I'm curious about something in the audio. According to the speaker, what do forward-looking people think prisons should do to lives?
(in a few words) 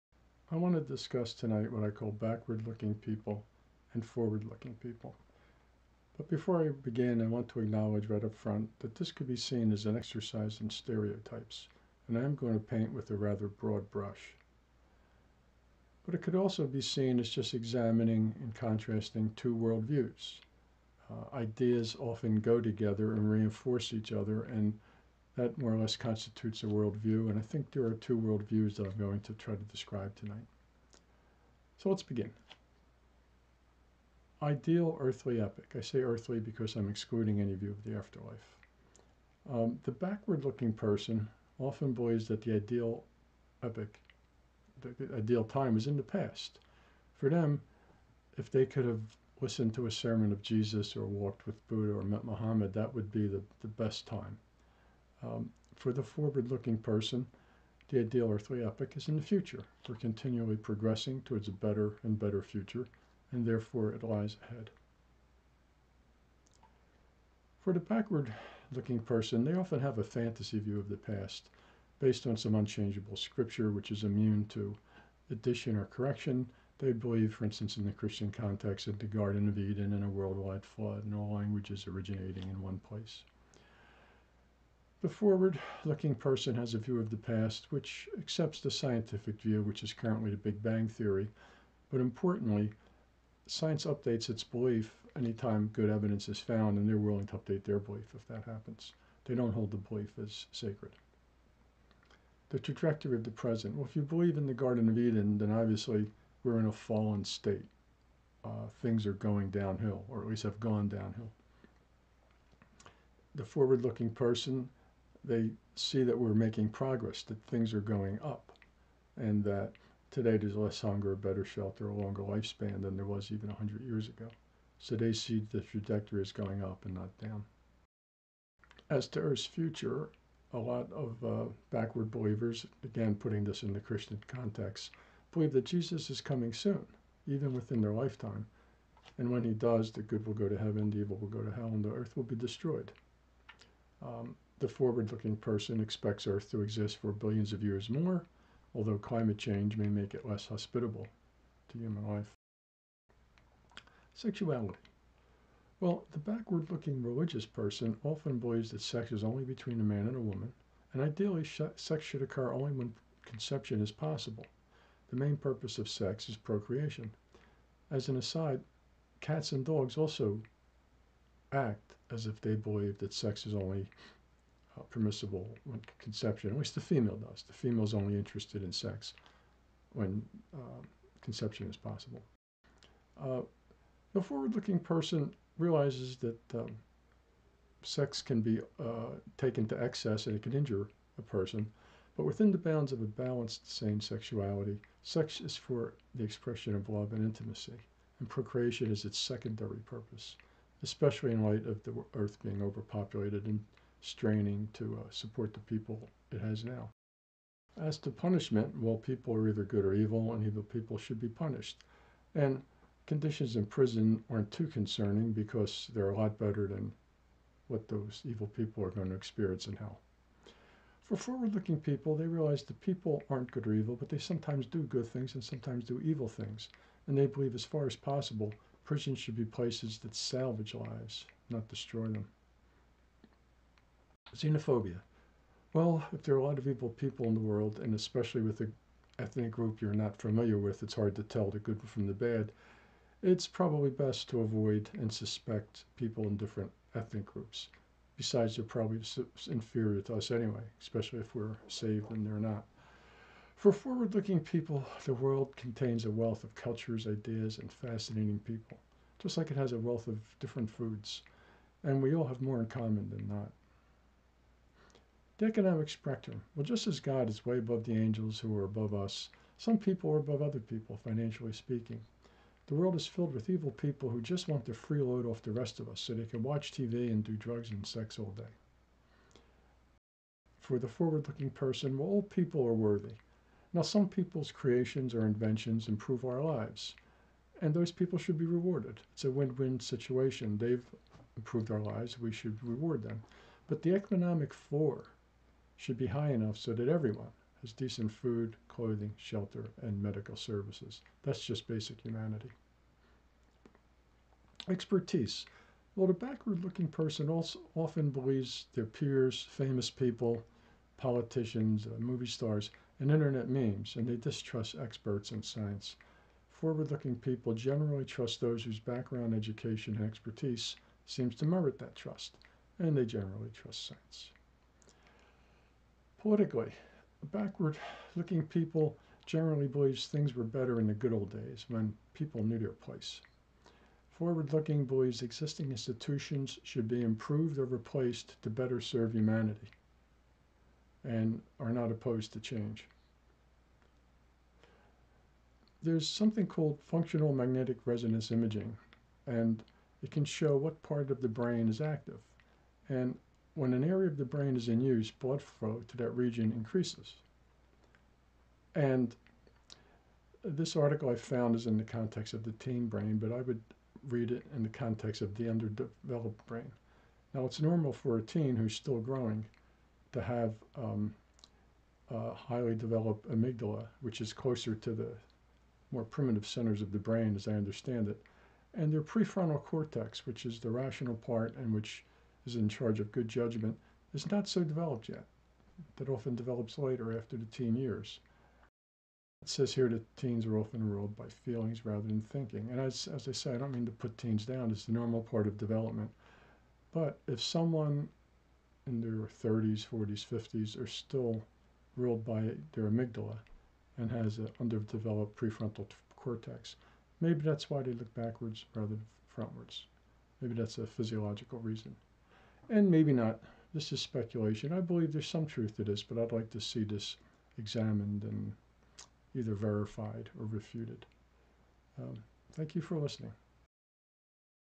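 salvage.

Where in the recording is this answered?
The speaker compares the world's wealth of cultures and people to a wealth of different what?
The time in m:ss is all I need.
4:20.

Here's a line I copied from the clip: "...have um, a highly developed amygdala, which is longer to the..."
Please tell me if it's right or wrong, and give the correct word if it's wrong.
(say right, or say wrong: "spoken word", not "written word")
wrong: "closer", not "longer".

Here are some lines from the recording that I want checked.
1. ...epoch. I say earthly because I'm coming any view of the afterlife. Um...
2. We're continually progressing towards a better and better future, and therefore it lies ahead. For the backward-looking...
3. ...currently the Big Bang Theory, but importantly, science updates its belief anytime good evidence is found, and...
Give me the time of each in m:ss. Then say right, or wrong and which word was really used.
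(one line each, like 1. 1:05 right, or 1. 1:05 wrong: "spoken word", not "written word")
1. 0:35 wrong: "excluding", not "coming"
2. 0:59 right
3. 1:29 right.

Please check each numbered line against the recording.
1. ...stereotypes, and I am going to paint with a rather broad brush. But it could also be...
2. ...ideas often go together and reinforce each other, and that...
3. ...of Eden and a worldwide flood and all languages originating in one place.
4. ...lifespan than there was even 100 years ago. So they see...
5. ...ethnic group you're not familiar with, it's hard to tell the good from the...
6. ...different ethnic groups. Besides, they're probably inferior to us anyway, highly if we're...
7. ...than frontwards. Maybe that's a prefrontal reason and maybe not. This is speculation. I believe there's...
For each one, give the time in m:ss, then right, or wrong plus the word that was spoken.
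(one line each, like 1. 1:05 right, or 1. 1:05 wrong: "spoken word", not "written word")
1. 0:10 right
2. 0:21 right
3. 1:19 right
4. 2:02 right
5. 3:59 right
6. 4:06 wrong: "especially", not "highly"
7. 6:48 wrong: "physiological", not "prefrontal".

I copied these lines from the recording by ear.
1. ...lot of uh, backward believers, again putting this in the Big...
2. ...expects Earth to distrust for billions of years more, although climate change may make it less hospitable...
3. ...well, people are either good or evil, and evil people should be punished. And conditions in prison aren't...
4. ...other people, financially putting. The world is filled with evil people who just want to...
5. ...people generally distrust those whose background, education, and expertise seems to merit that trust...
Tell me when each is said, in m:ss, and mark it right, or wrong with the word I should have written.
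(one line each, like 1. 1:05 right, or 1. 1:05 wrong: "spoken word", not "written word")
1. 2:10 wrong: "Christian", not "Big"
2. 2:25 wrong: "exist", not "distrust"
3. 3:28 right
4. 4:30 wrong: "speaking", not "putting"
5. 5:17 wrong: "trust", not "distrust".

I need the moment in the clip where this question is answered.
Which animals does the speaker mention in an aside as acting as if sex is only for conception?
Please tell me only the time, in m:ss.
2:49.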